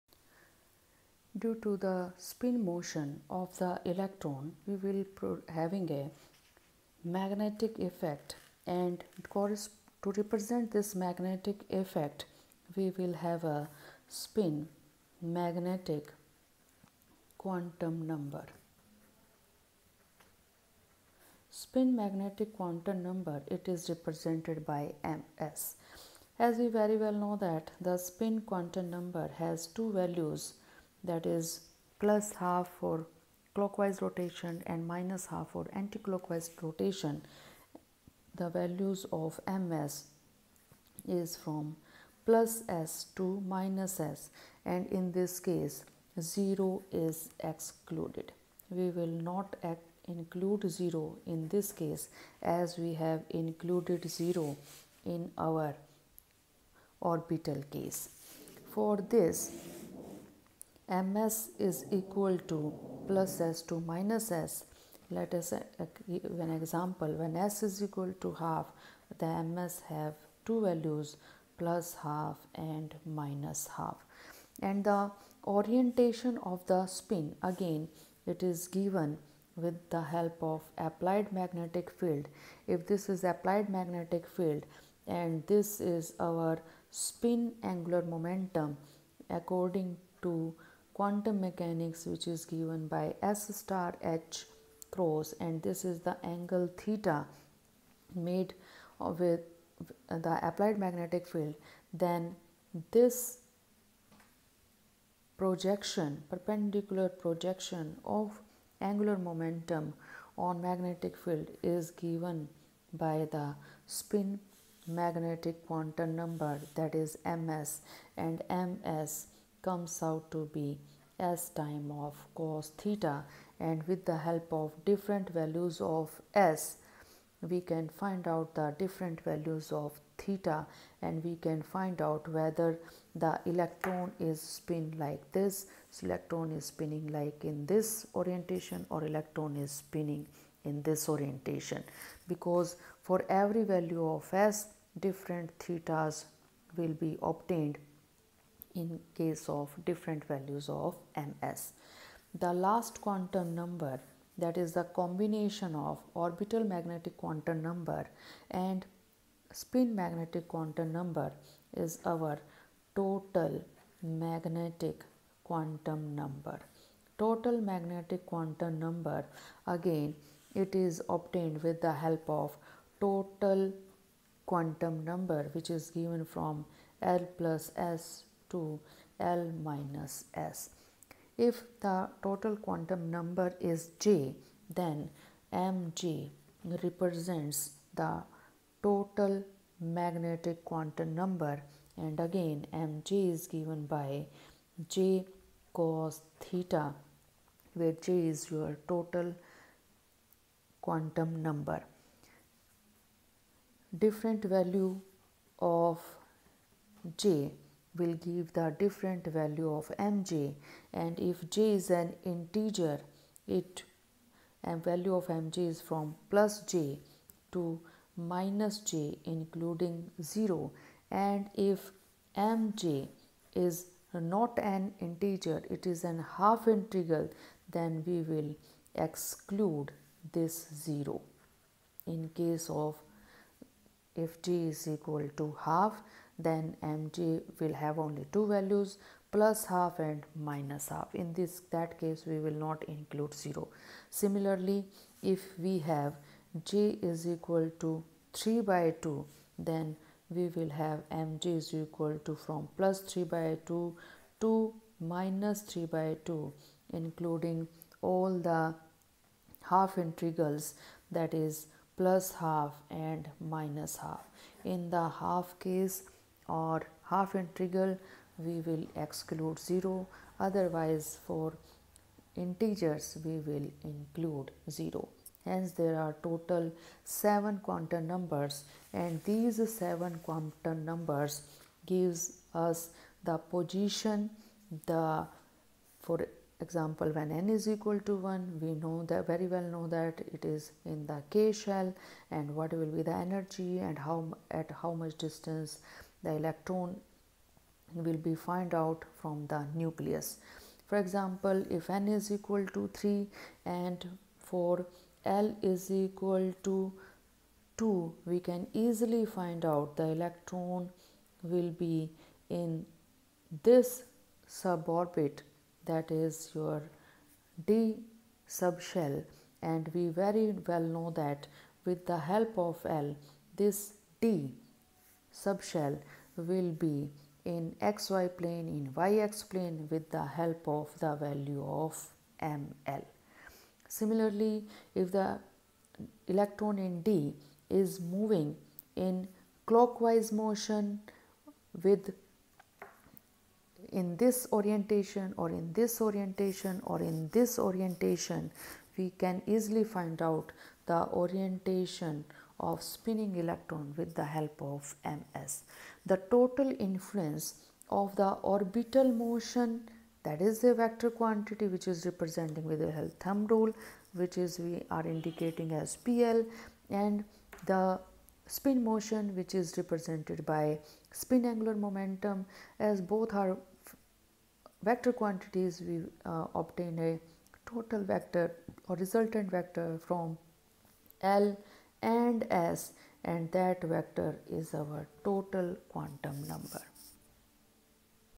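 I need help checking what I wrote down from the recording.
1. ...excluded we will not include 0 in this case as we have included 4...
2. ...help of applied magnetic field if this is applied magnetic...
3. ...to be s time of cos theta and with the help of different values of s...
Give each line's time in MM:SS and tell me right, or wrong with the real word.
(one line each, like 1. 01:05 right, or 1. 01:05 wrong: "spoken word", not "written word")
1. 00:47 wrong: "0", not "4"
2. 01:20 right
3. 02:00 right.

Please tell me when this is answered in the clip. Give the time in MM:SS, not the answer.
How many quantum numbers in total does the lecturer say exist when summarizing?
04:36.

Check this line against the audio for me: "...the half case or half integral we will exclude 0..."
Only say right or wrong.
right.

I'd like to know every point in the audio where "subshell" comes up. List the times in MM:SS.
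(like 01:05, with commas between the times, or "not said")
05:18, 05:25.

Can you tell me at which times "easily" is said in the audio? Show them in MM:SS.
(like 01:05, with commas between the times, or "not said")
05:08, 05:49.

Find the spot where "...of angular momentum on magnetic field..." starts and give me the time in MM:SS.
01:48.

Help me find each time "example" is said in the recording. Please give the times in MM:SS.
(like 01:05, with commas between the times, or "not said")
01:06, 04:46, 05:00.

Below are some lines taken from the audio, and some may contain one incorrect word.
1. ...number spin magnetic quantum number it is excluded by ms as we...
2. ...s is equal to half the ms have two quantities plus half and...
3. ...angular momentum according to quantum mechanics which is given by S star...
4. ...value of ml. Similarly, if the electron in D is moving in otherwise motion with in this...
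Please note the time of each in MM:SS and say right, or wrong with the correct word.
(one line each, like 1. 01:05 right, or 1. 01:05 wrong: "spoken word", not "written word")
1. 00:18 wrong: "represented", not "excluded"
2. 01:07 wrong: "values", not "quantities"
3. 01:27 right
4. 05:31 wrong: "clockwise", not "otherwise".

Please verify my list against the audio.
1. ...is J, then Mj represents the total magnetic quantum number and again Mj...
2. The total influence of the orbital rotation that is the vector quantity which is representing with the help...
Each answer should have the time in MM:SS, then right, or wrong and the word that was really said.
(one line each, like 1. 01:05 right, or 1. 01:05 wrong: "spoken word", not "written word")
1. 03:03 right
2. 05:56 wrong: "motion", not "rotation".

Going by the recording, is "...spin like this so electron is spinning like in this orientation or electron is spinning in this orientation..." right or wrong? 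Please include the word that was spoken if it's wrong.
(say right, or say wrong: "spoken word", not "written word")
right.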